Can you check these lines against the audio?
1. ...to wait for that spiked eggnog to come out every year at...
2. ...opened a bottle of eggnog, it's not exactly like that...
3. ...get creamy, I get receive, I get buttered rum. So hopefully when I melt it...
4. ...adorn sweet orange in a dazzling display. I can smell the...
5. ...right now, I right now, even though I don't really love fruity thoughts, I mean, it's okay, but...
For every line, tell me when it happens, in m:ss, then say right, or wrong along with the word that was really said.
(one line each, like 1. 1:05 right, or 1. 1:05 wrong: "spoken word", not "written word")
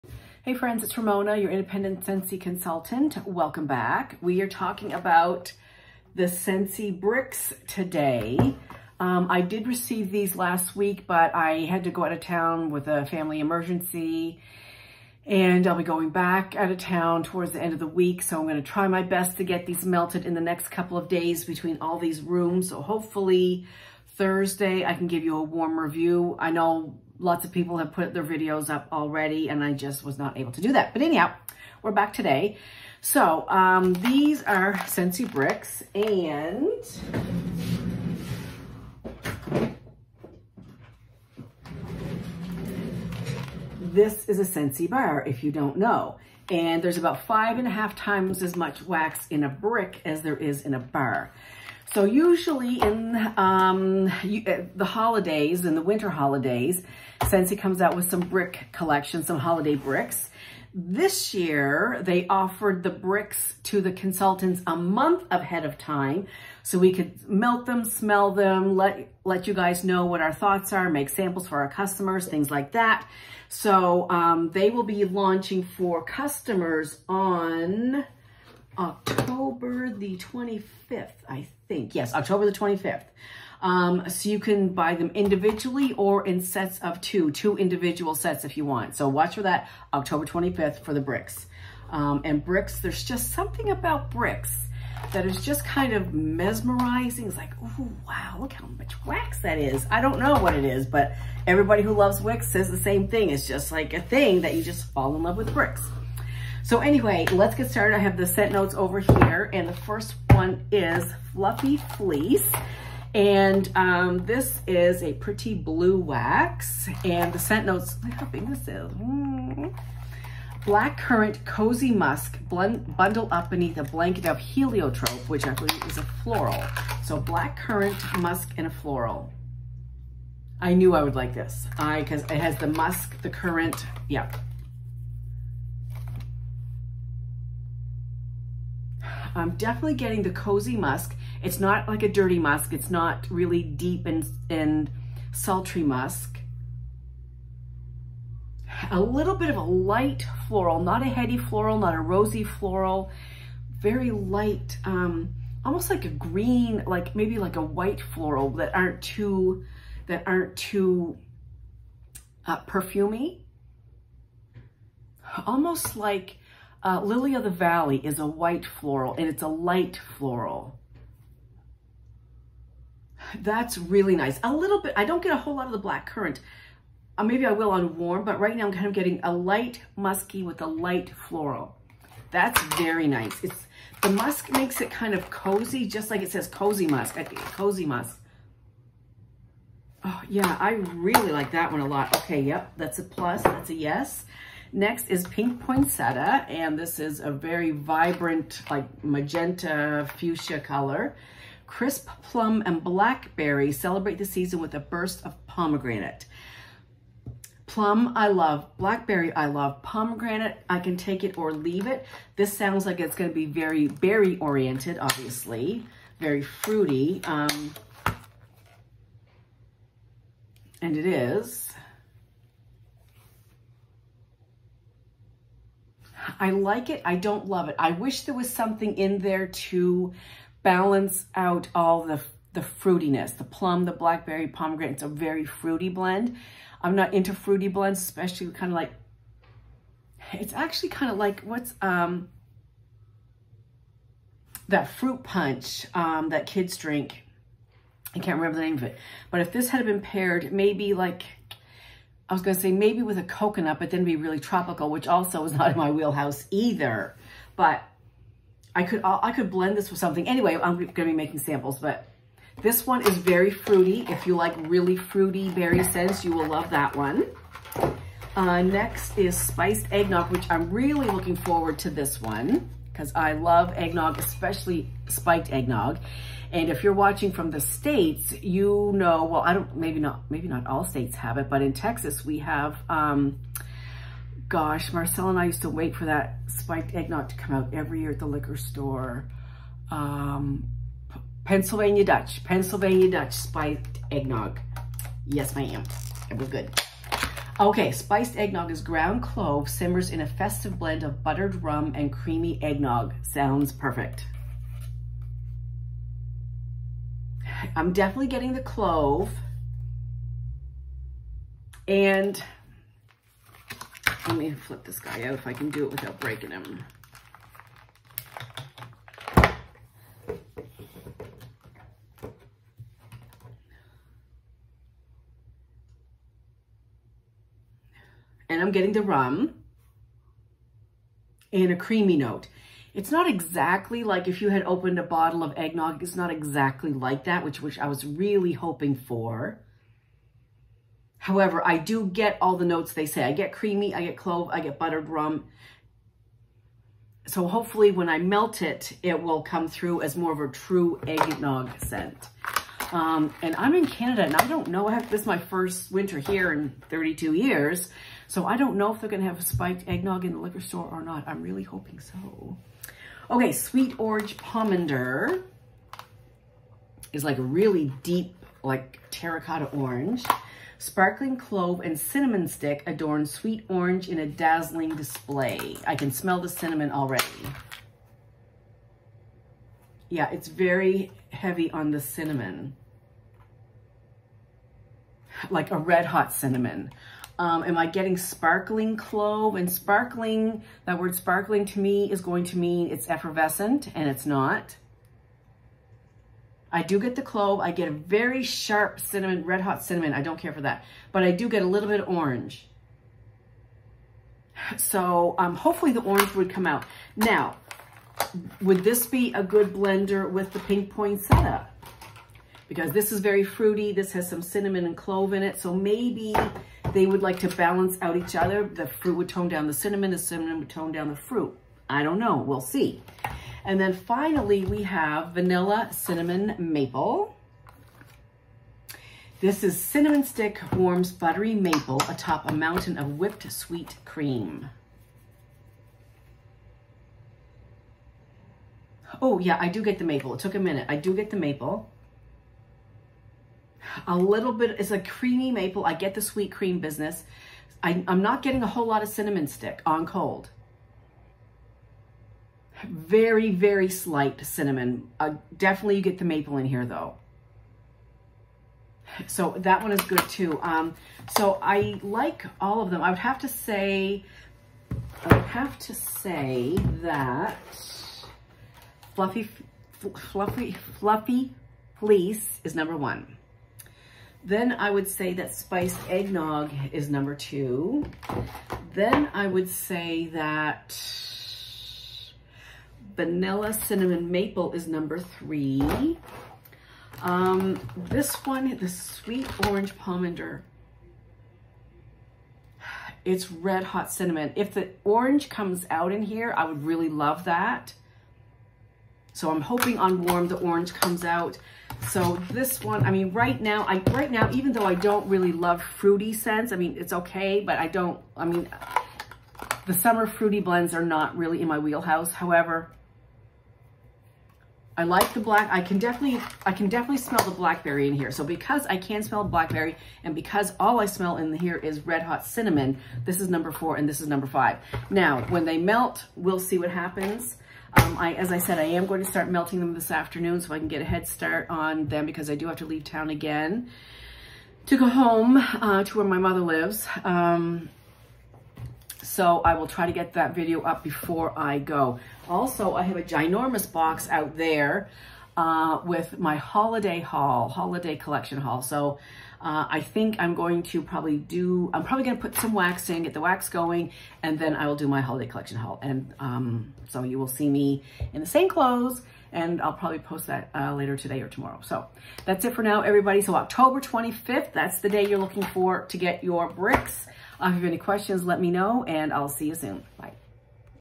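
1. 4:45 right
2. 5:34 right
3. 5:43 wrong: "clove", not "receive"
4. 6:12 right
5. 8:23 wrong: "scents", not "thoughts".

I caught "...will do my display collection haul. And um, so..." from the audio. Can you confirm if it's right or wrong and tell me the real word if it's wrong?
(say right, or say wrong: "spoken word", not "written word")
wrong: "holiday", not "display".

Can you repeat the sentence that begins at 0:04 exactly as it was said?
We are talking about the Scentsy bricks today.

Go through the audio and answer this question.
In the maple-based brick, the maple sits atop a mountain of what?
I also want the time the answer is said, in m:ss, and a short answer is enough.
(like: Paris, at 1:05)
whipped sweet cream, at 7:13.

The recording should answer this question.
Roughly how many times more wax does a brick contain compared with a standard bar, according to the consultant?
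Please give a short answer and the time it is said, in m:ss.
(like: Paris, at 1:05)
5.5 times, at 0:47.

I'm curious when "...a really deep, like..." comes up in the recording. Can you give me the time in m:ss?
6:07.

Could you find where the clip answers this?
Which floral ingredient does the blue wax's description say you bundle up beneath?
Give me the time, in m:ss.
2:04.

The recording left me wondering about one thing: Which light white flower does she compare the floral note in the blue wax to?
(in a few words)
Lily of the Valley.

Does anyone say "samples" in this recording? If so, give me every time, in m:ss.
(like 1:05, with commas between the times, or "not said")
1:11, 4:21.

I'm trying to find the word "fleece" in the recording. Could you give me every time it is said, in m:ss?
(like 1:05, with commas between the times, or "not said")
1:51, 7:51.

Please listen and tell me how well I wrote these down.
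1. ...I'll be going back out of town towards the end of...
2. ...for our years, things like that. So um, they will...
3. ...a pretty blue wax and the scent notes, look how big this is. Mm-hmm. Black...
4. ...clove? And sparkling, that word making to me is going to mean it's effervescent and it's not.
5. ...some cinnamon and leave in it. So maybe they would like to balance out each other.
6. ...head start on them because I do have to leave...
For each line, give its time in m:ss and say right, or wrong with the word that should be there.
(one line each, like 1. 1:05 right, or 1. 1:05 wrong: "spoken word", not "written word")
1. 0:15 right
2. 1:11 wrong: "customers", not "years"
3. 1:55 right
4. 6:28 wrong: "sparkling", not "making"
5. 6:54 wrong: "clove", not "leave"
6. 8:51 right.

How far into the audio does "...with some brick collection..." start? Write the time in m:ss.
0:57.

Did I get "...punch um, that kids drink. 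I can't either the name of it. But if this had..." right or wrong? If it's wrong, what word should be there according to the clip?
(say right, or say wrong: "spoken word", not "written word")
wrong: "remember", not "either".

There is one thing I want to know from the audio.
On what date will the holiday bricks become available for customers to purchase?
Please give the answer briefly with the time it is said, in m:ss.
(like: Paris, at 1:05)
October 25th, at 1:18.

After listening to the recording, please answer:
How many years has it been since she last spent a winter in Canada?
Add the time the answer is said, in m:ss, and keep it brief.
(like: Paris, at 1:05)
32, at 5:56.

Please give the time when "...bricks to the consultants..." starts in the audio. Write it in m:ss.
1:02.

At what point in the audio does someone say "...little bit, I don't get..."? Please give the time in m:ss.
2:54.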